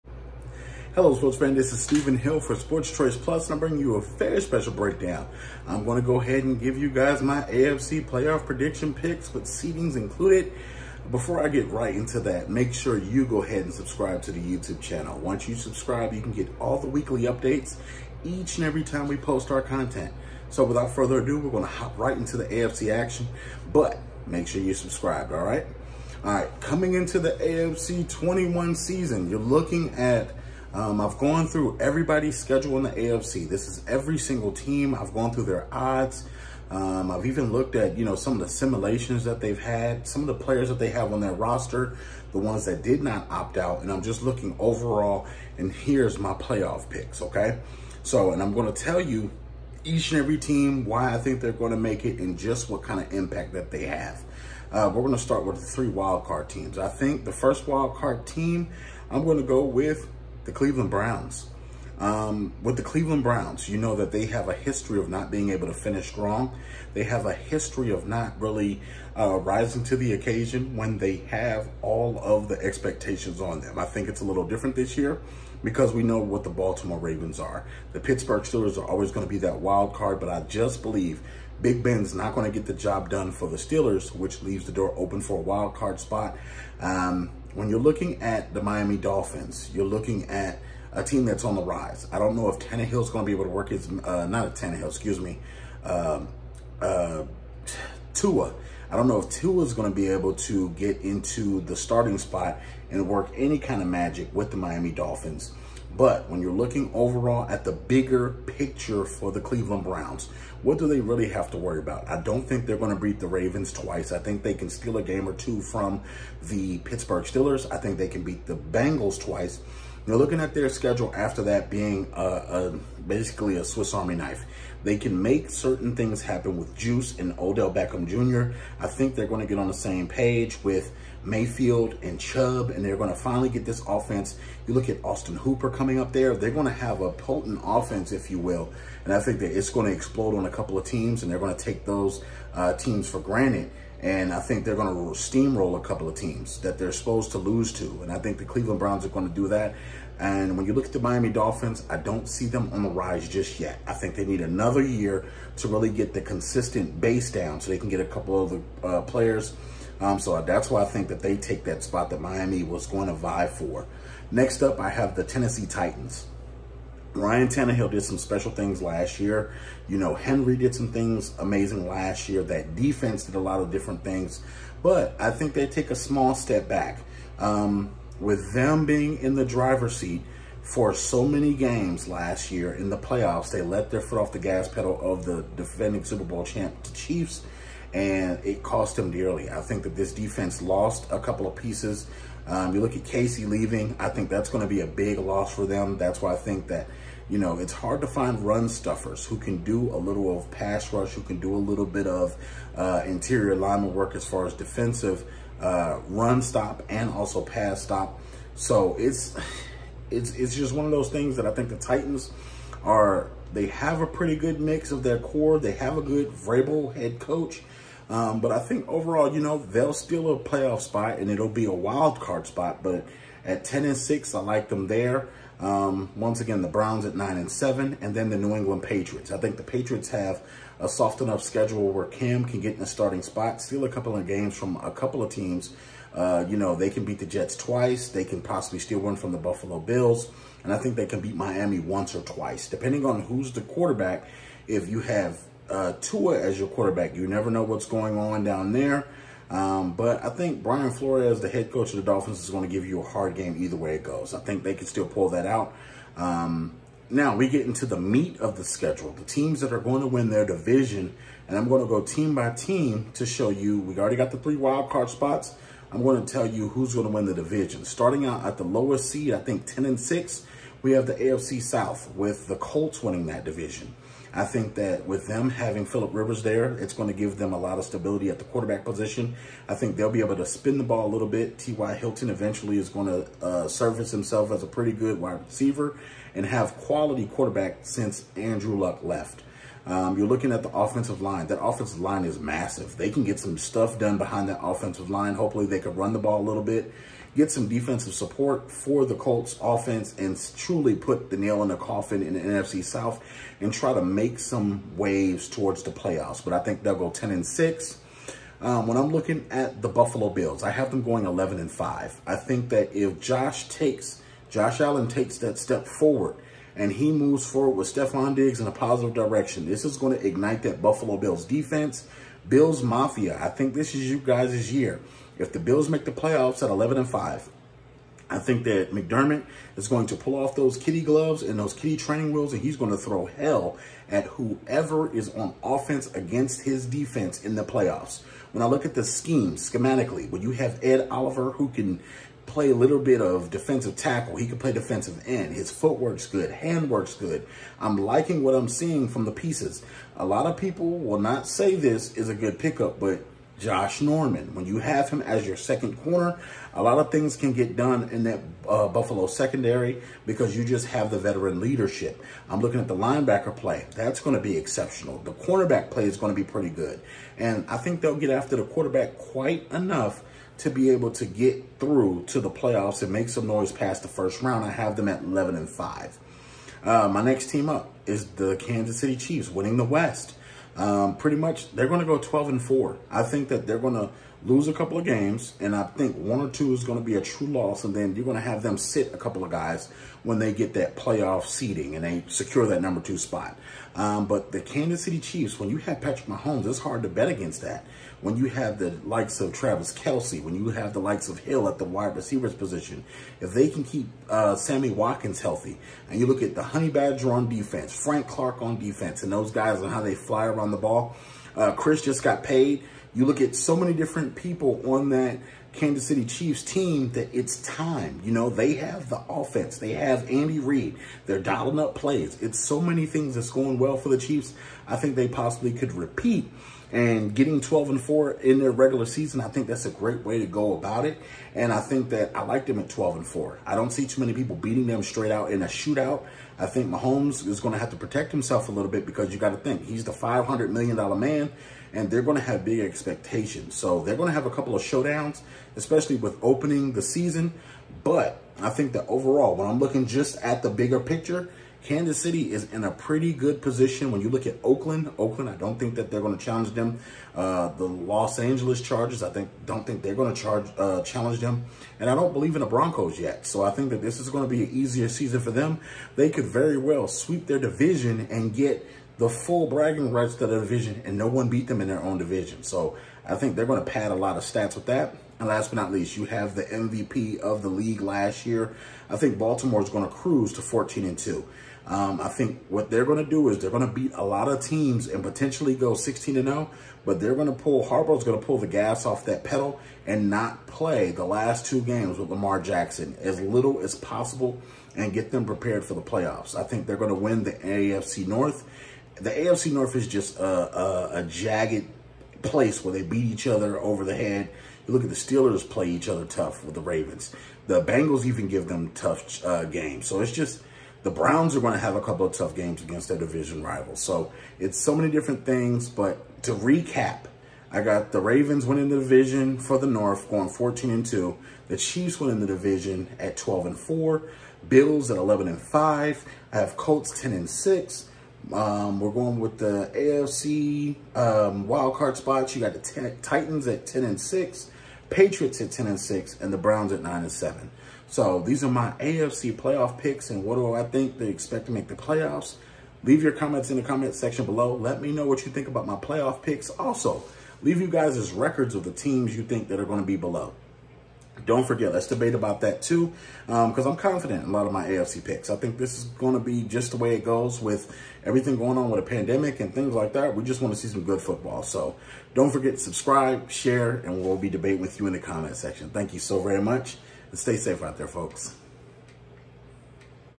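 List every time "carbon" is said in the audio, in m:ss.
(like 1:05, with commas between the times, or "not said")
not said.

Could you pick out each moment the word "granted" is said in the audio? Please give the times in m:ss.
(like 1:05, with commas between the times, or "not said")
2:23.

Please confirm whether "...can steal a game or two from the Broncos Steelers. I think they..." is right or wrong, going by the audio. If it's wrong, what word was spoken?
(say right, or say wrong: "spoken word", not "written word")
wrong: "Pittsburgh", not "Broncos".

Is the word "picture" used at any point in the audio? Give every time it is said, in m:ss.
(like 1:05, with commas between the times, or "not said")
1:48, 7:30.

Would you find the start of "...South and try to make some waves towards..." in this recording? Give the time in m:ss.
5:02.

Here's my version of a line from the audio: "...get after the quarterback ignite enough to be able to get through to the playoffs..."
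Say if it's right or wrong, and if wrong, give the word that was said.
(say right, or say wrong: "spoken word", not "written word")
wrong: "quite", not "ignite".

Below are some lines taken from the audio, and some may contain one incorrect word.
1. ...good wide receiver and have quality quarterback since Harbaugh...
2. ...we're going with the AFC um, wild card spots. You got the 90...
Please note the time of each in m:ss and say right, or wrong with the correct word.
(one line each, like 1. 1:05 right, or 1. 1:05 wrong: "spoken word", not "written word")
1. 4:44 wrong: "Andrew", not "Harbaugh"
2. 8:48 wrong: "10", not "90".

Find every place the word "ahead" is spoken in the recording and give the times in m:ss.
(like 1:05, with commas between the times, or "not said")
0:06, 0:13.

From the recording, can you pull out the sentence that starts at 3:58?
They can possibly steal one from the Buffalo Bills.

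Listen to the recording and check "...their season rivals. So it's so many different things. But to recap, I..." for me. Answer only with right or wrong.
wrong.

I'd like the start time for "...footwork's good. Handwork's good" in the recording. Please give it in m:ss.
5:45.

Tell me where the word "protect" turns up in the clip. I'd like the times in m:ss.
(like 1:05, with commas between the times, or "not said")
7:17.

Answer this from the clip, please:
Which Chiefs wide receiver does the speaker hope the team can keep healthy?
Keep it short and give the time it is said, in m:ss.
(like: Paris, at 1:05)
Sammy Watkins, at 6:44.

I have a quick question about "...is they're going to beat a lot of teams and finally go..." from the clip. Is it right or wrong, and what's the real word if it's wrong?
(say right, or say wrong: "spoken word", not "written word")
wrong: "potentially", not "finally".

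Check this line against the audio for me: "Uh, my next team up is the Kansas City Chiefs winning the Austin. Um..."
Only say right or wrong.
wrong.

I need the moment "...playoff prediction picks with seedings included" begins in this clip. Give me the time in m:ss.
0:08.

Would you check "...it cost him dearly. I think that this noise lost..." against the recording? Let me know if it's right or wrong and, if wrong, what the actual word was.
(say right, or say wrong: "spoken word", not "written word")
wrong: "defense", not "noise".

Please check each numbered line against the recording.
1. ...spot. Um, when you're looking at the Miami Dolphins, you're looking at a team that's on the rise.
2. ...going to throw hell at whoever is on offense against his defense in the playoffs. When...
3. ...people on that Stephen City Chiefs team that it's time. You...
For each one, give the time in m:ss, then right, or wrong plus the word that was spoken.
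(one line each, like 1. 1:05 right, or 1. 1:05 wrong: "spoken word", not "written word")
1. 1:25 right
2. 5:32 right
3. 6:54 wrong: "Kansas", not "Stephen".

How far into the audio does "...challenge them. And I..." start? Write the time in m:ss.
7:41.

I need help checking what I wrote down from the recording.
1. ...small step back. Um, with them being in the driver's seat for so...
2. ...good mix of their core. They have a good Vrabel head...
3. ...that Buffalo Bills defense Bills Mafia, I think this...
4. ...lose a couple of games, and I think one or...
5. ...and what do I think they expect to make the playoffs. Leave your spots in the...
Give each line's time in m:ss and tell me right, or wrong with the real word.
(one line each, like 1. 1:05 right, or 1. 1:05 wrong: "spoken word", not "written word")
1. 2:55 right
2. 3:34 right
3. 5:20 right
4. 6:24 right
5. 9:00 wrong: "comments", not "spots".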